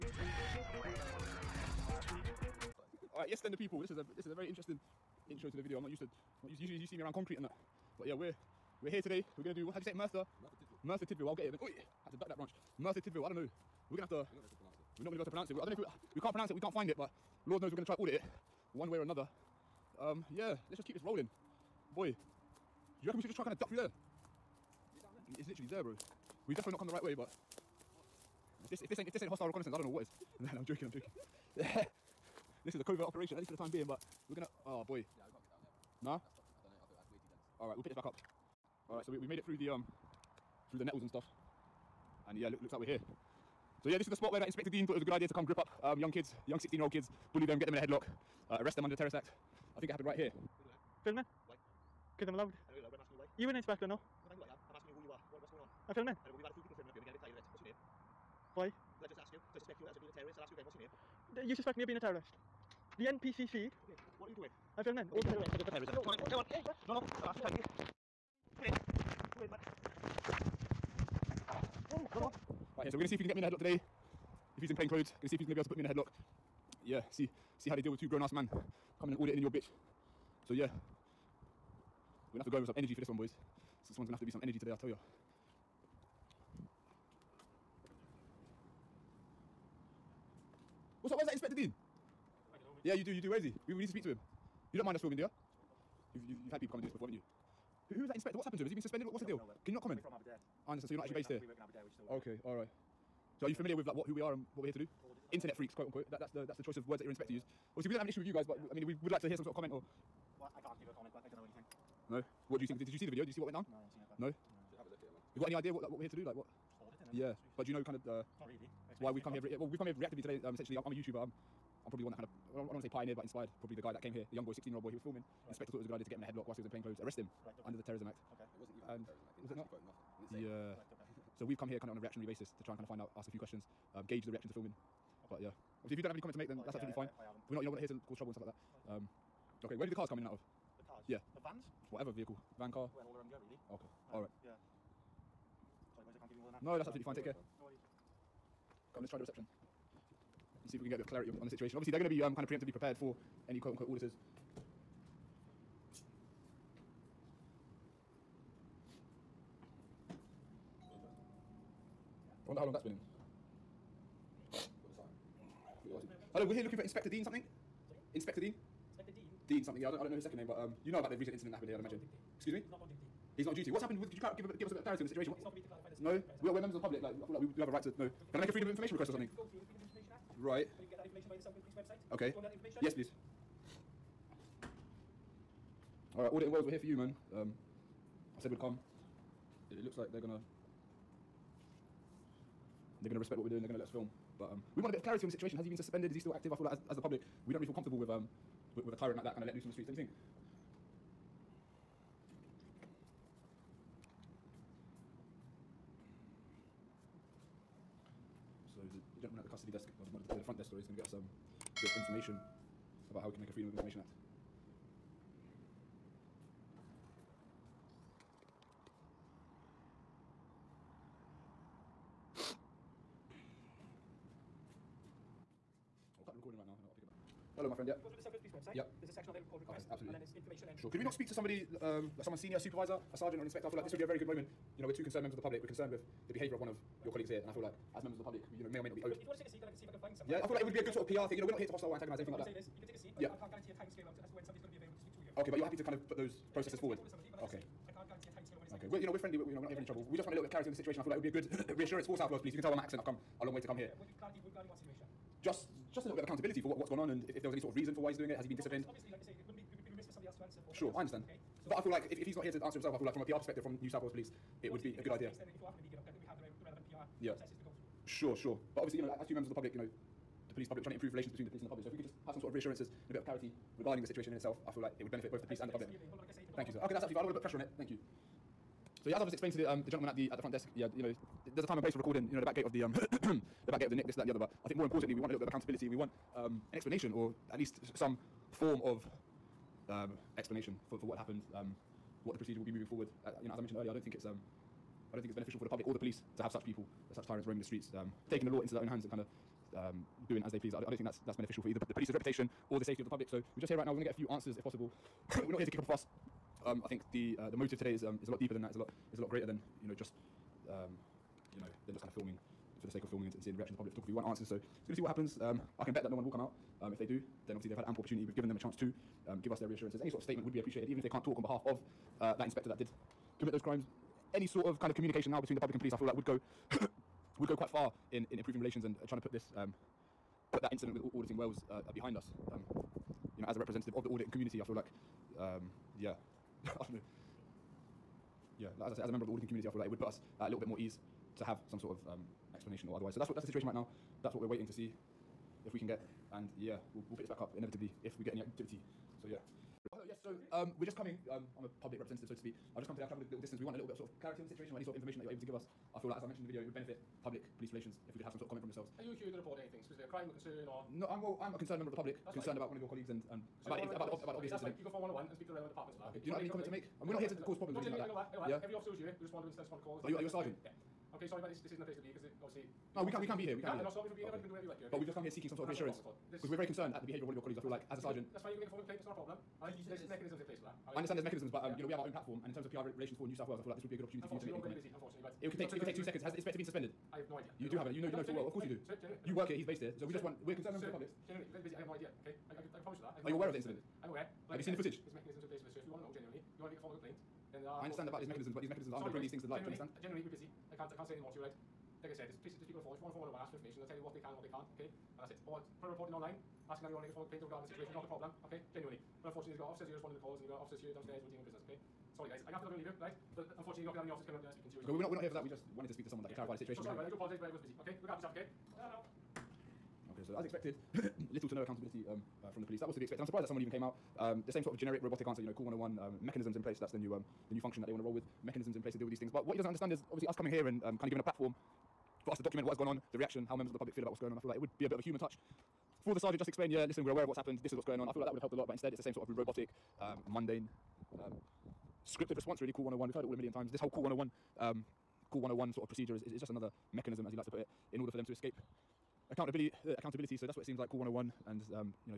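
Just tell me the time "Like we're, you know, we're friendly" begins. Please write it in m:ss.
4:08.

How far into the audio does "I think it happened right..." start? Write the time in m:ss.
0:49.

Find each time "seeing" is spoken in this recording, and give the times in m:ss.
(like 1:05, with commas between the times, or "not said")
5:13.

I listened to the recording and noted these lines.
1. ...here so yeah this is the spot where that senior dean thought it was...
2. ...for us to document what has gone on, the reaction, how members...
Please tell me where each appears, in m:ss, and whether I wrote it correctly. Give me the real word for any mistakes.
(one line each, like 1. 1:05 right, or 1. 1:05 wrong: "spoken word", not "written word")
1. 0:42 wrong: "inspector", not "senior"
2. 7:12 right.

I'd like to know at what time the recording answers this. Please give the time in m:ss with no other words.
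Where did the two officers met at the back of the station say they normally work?
1:39.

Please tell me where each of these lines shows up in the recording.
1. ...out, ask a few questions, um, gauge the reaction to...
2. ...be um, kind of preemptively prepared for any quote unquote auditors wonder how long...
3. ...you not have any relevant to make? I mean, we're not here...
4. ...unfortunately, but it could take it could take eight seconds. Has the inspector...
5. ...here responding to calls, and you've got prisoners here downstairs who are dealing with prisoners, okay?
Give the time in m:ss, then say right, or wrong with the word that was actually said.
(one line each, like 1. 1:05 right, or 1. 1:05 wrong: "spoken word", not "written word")
1. 2:12 right
2. 2:32 right
3. 6:06 wrong: "comment", not "relevant"
4. 6:24 wrong: "two", not "eight"
5. 6:49 wrong: "officers", not "prisoners".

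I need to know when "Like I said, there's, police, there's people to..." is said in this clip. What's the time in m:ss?
6:42.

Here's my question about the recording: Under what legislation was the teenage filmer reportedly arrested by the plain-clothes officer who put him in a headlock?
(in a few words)
the Terrorism Act.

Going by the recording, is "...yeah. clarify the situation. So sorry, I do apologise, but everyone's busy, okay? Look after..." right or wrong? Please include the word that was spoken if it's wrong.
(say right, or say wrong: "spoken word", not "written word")
right.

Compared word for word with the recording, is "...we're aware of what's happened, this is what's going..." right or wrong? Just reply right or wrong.
right.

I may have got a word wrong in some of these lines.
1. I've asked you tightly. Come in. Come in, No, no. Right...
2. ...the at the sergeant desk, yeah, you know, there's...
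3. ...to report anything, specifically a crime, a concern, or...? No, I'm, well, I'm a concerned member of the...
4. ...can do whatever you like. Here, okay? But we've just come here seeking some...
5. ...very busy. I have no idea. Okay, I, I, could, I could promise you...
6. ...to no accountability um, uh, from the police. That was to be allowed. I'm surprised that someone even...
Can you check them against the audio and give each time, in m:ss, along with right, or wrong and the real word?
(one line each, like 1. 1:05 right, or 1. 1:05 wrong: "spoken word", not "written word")
1. 1:07 right
2. 4:40 wrong: "front", not "sergeant"
3. 5:59 right
4. 6:14 right
5. 6:31 right
6. 7:01 wrong: "expected", not "allowed".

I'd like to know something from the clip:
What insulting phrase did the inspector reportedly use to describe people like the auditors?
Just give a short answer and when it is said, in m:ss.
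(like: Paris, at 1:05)
Internet freaks, at 1:45.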